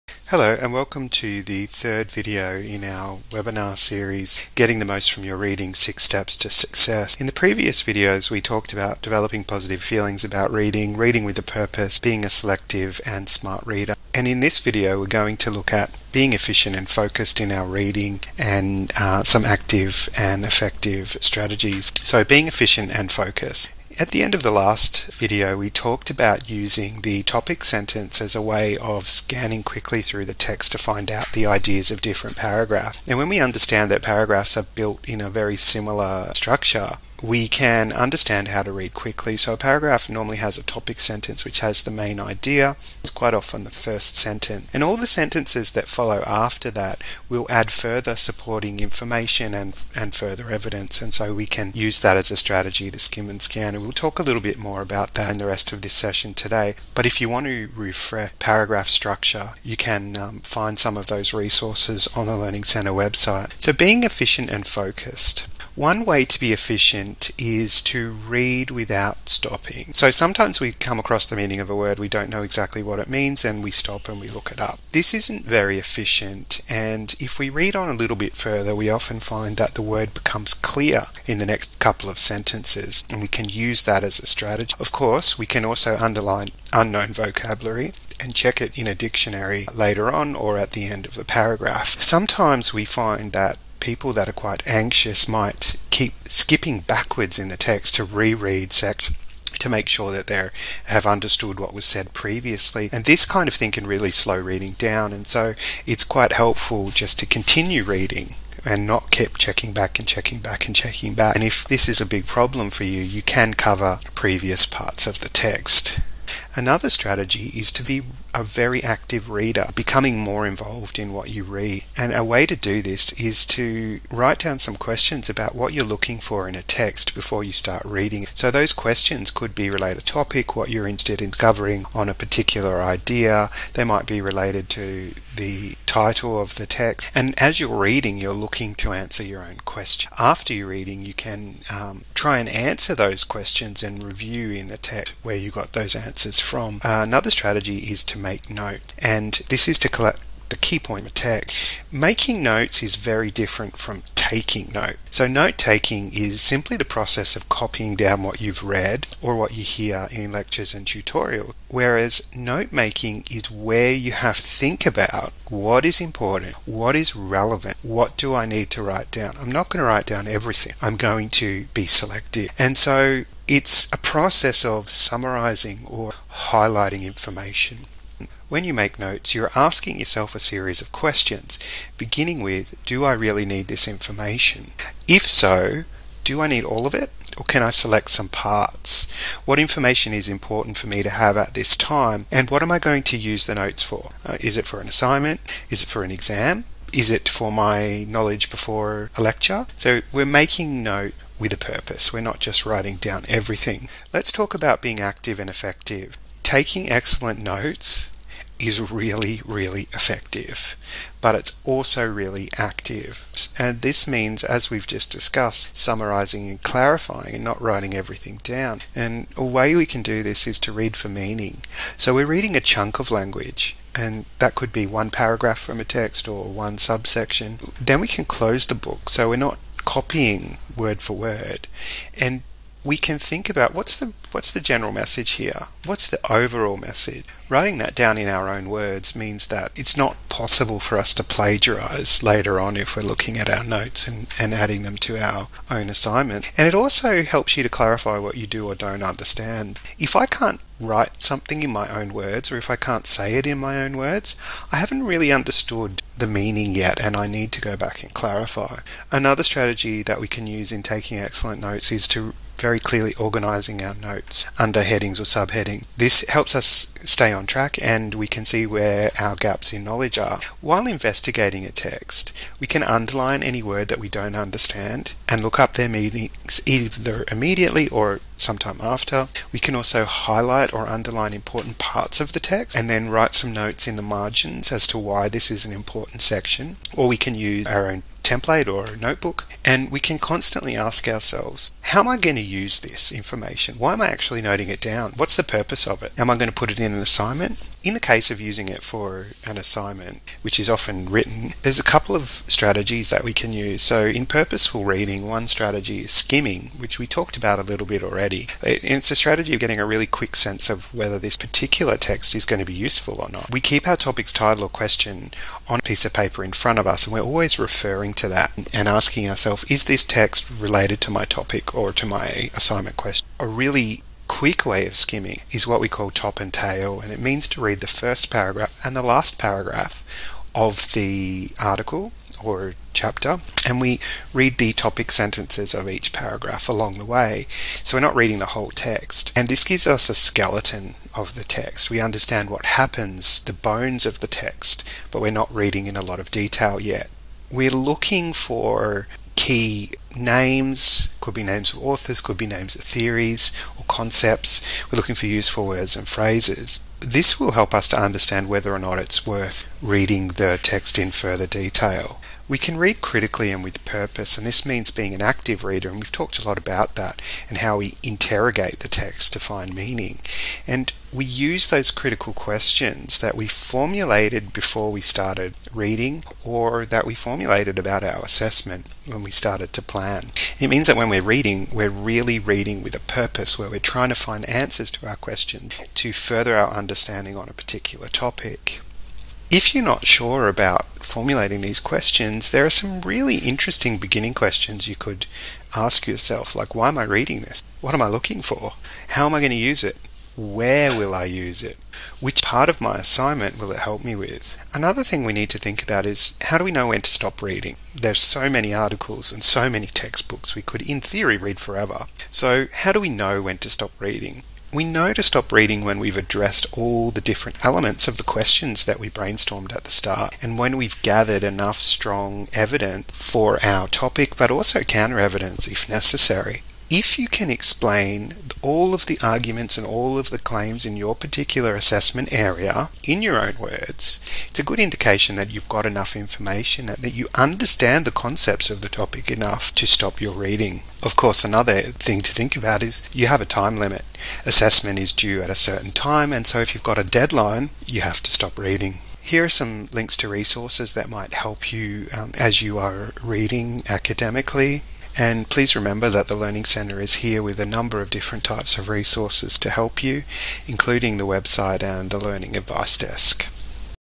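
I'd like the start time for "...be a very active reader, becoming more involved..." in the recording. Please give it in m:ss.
1:57.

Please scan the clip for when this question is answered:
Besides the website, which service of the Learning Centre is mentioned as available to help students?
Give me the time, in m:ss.
7:42.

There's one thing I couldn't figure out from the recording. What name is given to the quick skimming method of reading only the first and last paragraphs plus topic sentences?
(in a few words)
top and tail.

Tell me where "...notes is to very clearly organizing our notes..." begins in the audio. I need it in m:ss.
4:21.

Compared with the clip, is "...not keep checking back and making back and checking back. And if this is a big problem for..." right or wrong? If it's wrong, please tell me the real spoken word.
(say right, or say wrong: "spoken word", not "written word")
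wrong: "checking", not "making".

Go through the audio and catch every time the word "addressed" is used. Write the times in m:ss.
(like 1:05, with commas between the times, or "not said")
6:56.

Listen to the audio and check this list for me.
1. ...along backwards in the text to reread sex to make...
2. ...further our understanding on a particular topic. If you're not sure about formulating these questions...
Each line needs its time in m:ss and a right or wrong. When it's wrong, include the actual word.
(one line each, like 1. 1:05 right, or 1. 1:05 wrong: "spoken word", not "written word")
1. 1:36 wrong: "skipping", not "along"
2. 6:26 right.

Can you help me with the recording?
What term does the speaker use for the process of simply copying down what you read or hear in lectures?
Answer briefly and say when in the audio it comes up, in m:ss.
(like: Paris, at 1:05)
note taking, at 2:35.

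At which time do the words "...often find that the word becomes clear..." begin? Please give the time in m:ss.
1:18.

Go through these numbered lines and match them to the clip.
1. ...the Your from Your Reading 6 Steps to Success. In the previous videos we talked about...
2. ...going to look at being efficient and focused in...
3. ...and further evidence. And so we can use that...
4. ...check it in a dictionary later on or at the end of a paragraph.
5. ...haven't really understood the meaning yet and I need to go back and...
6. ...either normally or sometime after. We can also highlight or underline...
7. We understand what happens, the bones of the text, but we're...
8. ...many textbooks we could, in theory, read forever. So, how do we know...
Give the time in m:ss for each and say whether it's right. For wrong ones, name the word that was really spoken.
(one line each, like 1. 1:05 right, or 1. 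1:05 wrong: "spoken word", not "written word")
1. 0:04 wrong: "Most", not "Your"
2. 0:15 right
3. 0:49 right
4. 1:28 right
5. 4:14 right
6. 4:36 wrong: "immediately", not "normally"
7. 5:41 right
8. 6:49 right.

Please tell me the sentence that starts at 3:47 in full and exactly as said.
Then we can close the book so we're not copying word for word.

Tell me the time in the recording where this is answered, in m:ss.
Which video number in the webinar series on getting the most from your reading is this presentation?
0:01.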